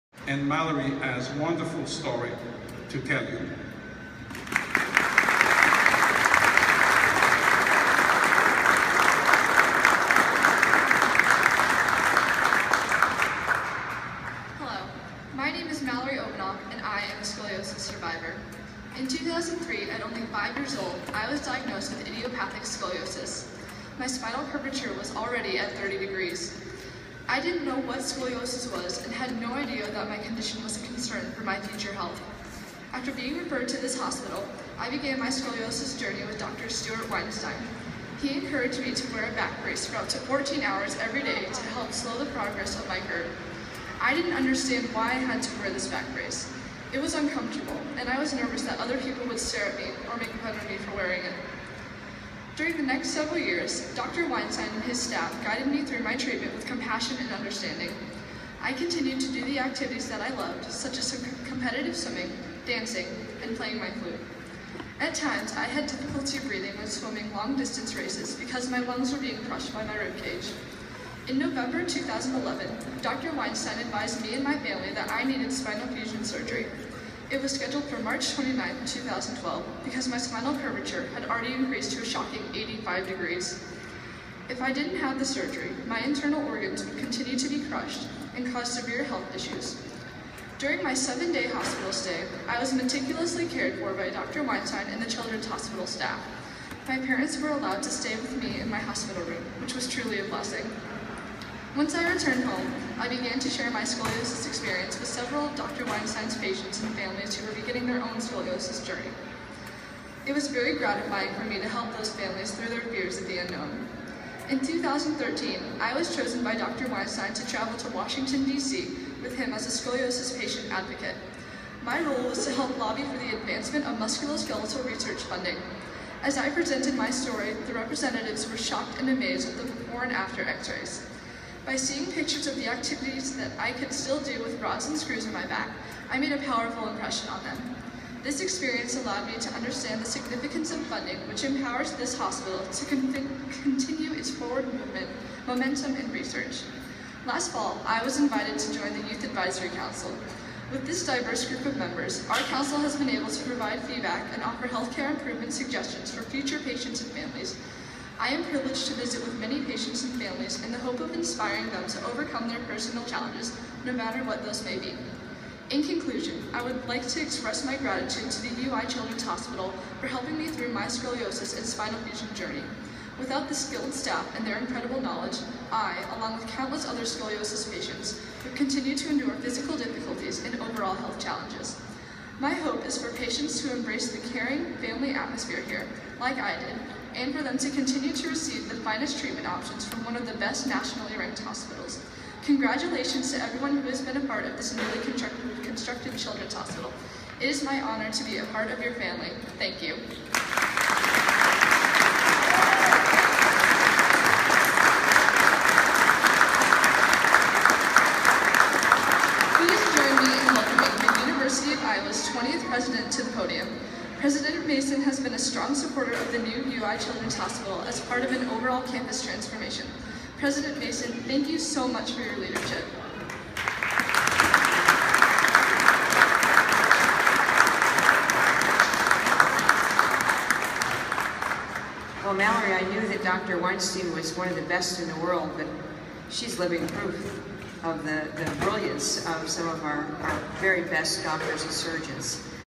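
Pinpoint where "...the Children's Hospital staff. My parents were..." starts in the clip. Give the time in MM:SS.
01:35.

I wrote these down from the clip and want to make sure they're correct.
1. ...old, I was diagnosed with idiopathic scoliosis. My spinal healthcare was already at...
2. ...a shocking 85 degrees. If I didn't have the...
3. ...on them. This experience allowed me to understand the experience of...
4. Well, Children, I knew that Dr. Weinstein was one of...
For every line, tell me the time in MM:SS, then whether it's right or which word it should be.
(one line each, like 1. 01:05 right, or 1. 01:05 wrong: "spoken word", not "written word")
1. 00:20 wrong: "curvature", not "healthcare"
2. 01:22 right
3. 02:17 wrong: "significance", not "experience"
4. 03:52 wrong: "Mallory", not "Children".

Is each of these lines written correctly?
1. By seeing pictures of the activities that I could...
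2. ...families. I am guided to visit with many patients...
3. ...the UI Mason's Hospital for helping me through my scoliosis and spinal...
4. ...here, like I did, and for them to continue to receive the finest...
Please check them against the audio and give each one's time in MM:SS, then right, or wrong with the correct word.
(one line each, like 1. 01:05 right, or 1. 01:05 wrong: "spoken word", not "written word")
1. 02:11 right
2. 02:37 wrong: "privileged", not "guided"
3. 02:48 wrong: "Children", not "Mason"
4. 03:05 right.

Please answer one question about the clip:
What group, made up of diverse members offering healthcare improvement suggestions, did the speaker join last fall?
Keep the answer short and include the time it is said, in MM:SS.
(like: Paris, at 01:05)
Youth Advisory Council, at 02:29.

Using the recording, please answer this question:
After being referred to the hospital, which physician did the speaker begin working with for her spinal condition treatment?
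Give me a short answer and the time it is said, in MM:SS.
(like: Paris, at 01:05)
Stuart Weinstein, at 00:36.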